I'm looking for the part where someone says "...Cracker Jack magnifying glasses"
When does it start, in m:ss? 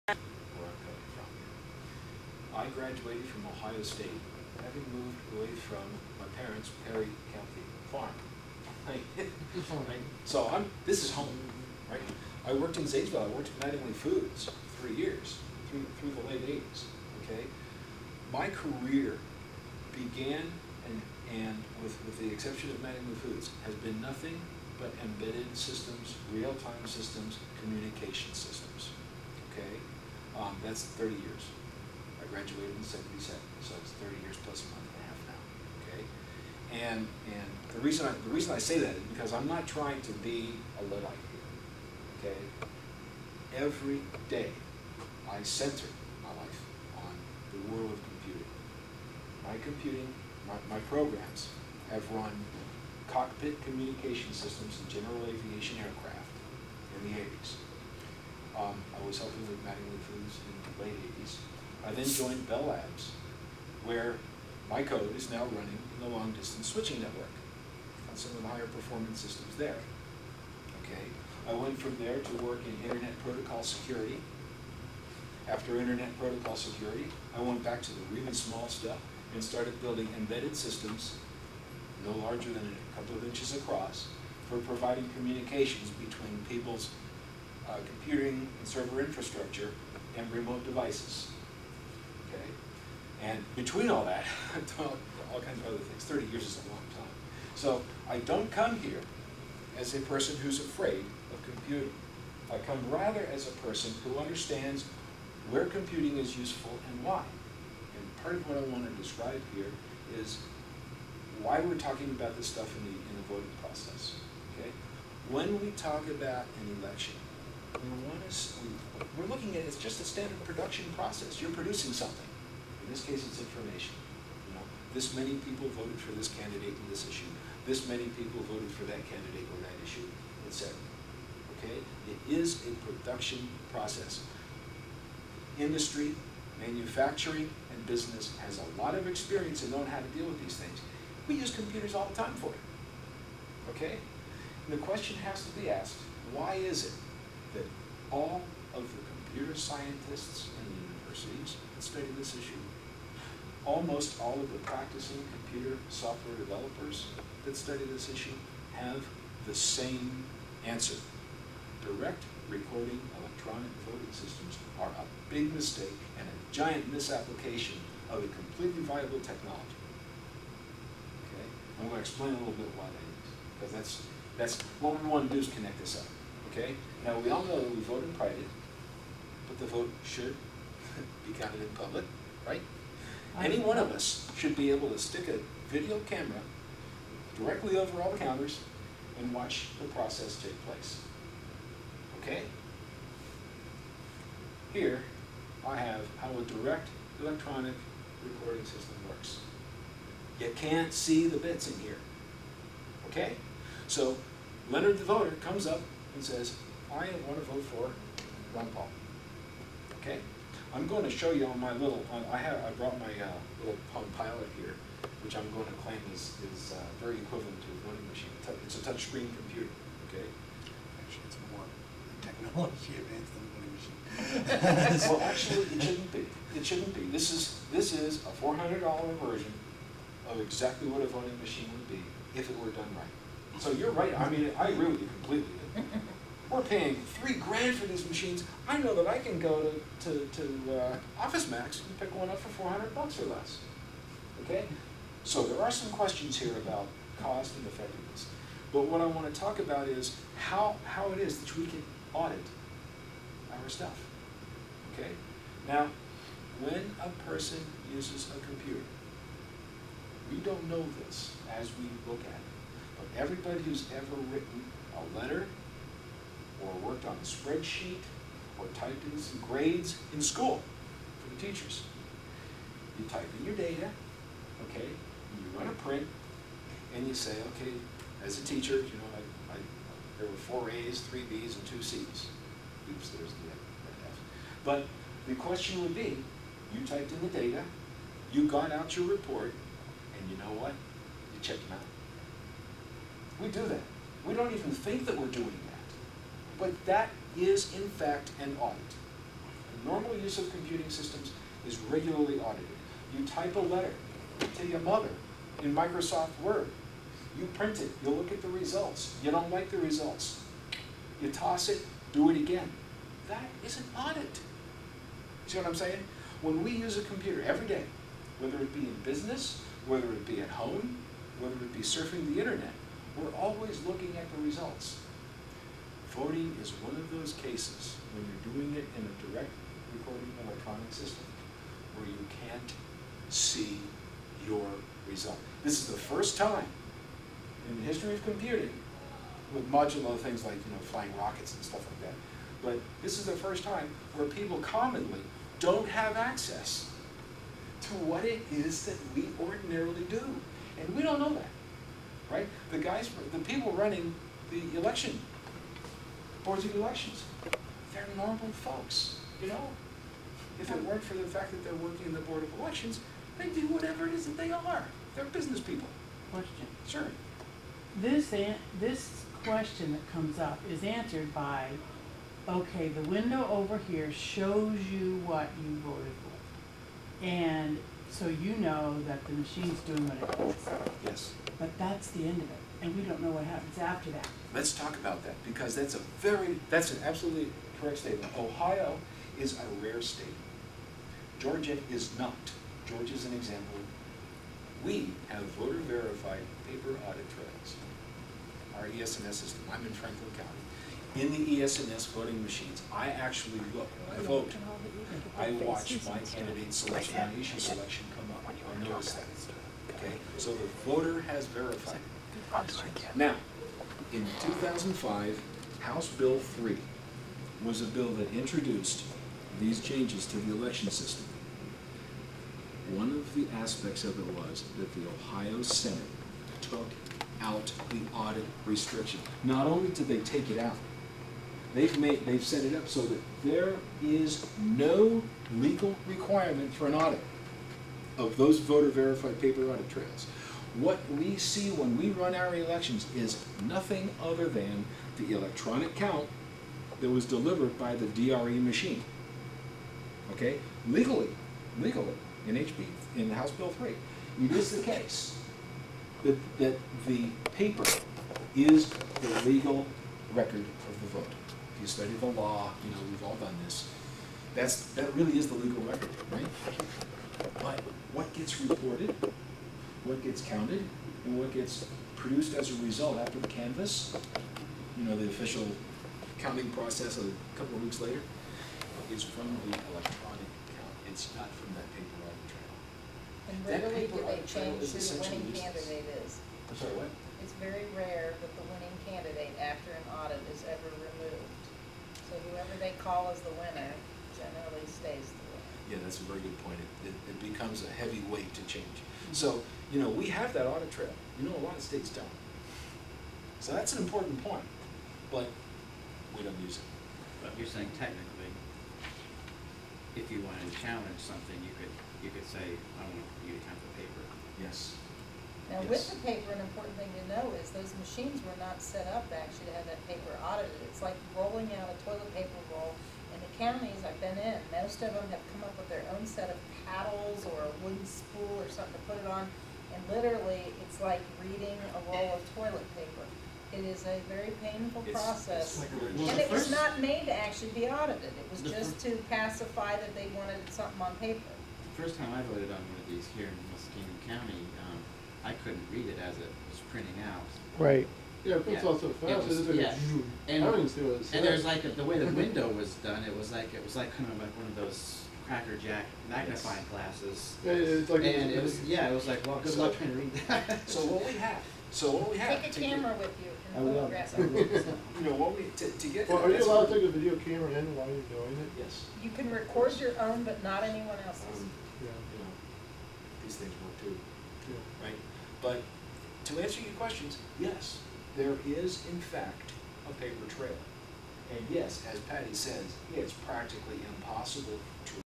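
9:15.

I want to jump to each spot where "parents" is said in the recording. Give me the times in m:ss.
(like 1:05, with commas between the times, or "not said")
0:06.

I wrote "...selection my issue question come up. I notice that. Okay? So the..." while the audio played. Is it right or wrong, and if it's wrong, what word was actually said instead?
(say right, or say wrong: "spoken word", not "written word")
wrong: "selection", not "question".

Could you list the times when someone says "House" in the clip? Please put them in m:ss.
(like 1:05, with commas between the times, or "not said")
6:55, 7:33.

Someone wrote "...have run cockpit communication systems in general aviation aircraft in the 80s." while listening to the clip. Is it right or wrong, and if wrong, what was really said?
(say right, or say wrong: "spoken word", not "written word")
right.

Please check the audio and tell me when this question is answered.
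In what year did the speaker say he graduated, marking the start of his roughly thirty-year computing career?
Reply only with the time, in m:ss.
0:32.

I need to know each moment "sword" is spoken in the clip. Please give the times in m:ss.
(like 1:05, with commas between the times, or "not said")
not said.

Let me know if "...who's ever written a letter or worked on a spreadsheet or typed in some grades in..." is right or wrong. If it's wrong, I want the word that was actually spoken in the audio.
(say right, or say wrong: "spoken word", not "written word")
right.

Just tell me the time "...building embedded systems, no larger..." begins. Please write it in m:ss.
1:19.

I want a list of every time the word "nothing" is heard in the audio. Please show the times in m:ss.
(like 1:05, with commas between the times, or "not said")
0:24, 7:23.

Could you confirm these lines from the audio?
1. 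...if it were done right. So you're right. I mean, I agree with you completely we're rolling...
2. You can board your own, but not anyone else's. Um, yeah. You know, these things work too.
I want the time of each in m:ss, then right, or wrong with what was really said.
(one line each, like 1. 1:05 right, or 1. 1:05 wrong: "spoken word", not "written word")
1. 3:52 wrong: "paying", not "rolling"
2. 9:29 wrong: "record", not "board".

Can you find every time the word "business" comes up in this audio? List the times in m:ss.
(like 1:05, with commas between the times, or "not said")
2:17, 5:19, 6:05.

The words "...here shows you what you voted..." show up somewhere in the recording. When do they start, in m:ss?
6:13.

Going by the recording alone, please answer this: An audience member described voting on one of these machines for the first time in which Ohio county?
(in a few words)
Muskingum County.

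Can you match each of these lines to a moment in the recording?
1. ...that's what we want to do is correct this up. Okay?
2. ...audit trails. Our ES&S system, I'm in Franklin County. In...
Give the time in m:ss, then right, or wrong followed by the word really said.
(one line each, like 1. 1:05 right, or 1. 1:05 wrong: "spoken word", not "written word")
1. 2:54 wrong: "connect", not "correct"
2. 6:37 right.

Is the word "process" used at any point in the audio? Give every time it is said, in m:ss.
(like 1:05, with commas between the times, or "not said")
1:53, 2:00, 2:13, 3:09, 7:56, 8:55.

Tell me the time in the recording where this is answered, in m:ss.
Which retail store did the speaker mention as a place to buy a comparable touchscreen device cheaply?
4:01.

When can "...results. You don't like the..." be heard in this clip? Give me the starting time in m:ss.
5:08.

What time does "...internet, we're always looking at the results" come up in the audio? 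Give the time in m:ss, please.
5:22.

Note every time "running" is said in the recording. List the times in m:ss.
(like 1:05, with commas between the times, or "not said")
1:05, 5:53.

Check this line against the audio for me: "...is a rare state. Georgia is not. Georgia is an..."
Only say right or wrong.
right.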